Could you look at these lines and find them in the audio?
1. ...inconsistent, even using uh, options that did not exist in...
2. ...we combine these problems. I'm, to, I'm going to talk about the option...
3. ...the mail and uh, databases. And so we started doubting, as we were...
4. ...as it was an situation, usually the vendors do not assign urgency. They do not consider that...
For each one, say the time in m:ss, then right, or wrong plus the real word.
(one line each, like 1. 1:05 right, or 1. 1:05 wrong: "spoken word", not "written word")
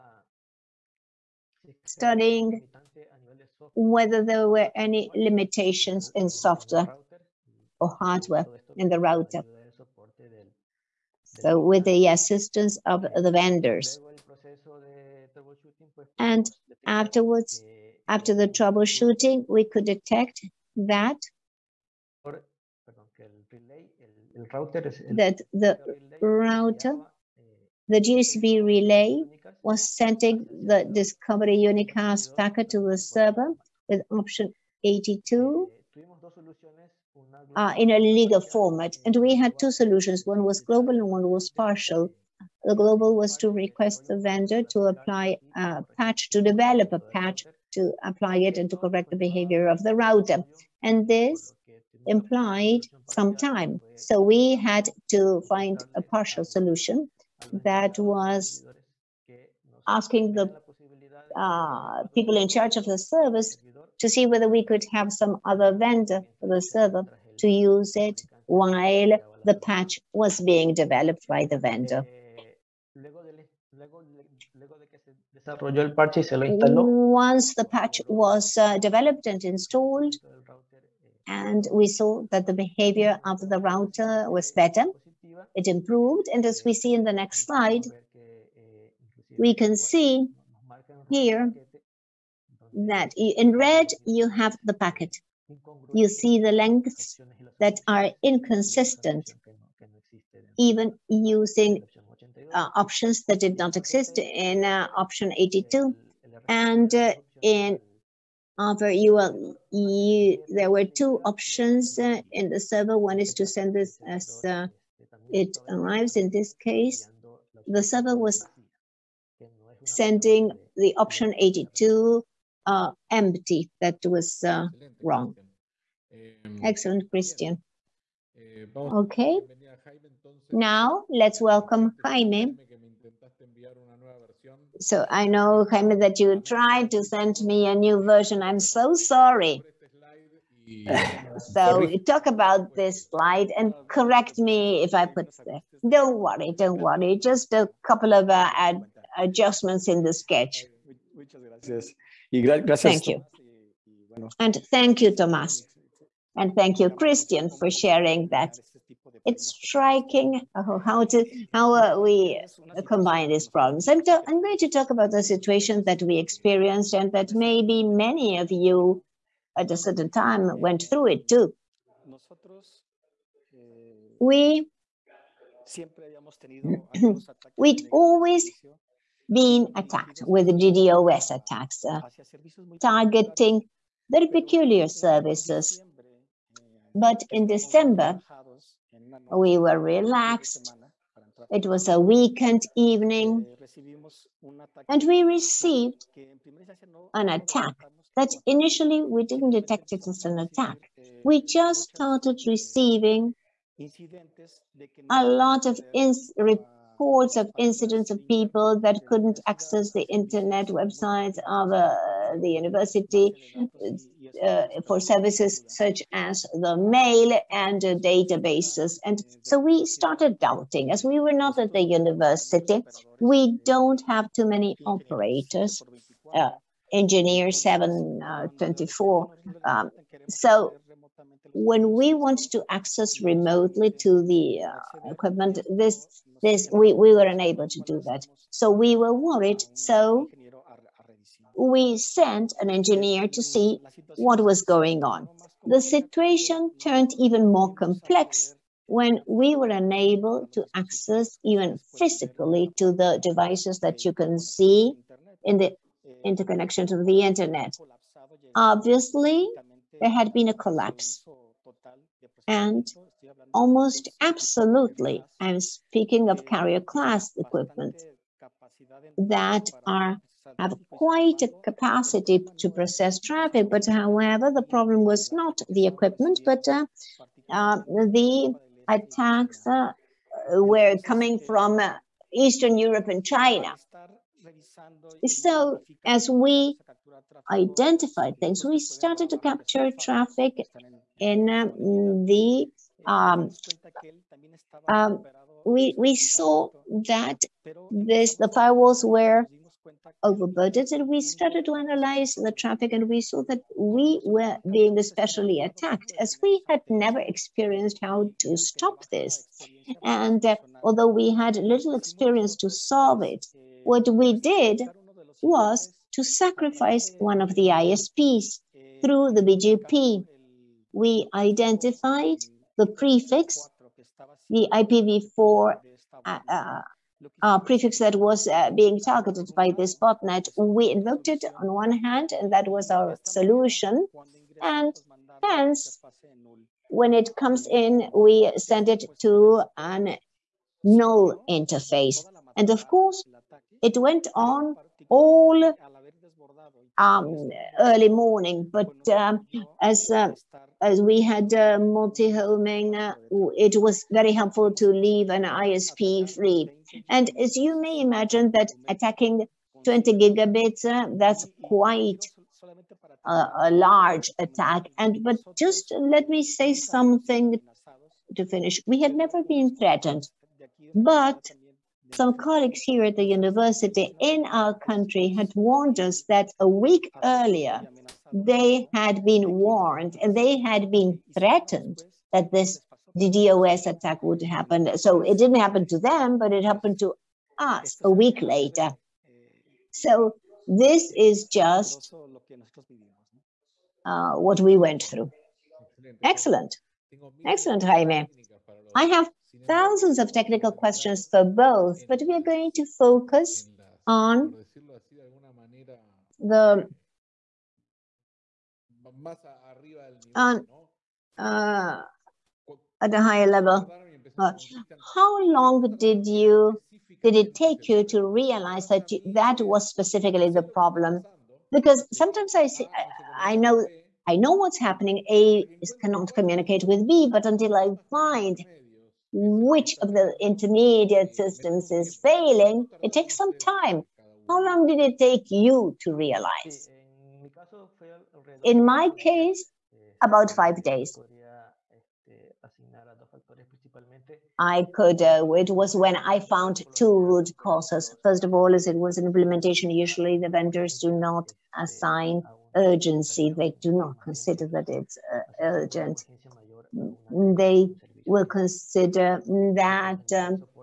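1. 1:38 right
2. 2:41 wrong: "situation", not "option"
3. 3:36 right
4. 7:28 wrong: "implementation", not "situation".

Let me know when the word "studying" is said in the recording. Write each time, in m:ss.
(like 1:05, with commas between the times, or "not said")
0:01.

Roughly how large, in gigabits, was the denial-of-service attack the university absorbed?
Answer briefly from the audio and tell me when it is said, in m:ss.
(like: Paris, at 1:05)
20 gigabits, at 5:59.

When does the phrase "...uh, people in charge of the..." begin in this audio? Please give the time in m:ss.
1:01.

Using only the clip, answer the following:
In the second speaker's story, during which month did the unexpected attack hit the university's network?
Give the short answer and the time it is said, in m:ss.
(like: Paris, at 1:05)
December, at 3:07.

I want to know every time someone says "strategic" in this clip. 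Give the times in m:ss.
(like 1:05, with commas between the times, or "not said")
not said.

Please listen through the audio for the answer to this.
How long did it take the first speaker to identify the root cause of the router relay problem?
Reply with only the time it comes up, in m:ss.
7:20.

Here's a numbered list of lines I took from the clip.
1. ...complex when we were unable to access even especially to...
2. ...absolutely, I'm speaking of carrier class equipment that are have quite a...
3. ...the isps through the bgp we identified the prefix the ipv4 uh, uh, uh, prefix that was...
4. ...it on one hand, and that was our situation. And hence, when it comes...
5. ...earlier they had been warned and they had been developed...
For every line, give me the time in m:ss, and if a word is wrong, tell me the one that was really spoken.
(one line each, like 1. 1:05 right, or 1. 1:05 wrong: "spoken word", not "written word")
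1. 4:07 wrong: "physically", not "especially"
2. 4:24 right
3. 5:17 right
4. 5:31 wrong: "solution", not "situation"
5. 6:17 wrong: "threatened", not "developed".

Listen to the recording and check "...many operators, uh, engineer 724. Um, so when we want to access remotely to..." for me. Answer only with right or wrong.
right.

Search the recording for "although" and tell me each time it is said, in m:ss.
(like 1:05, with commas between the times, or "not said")
5:10.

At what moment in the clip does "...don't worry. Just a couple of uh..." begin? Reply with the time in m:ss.
2:26.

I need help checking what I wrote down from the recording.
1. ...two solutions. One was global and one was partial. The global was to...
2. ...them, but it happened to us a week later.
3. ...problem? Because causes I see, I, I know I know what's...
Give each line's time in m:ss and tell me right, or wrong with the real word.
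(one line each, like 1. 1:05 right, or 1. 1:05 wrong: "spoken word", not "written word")
1. 0:39 right
2. 6:25 right
3. 7:00 wrong: "sometimes", not "causes".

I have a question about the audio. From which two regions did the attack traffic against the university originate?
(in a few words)
Eastern Europe and China.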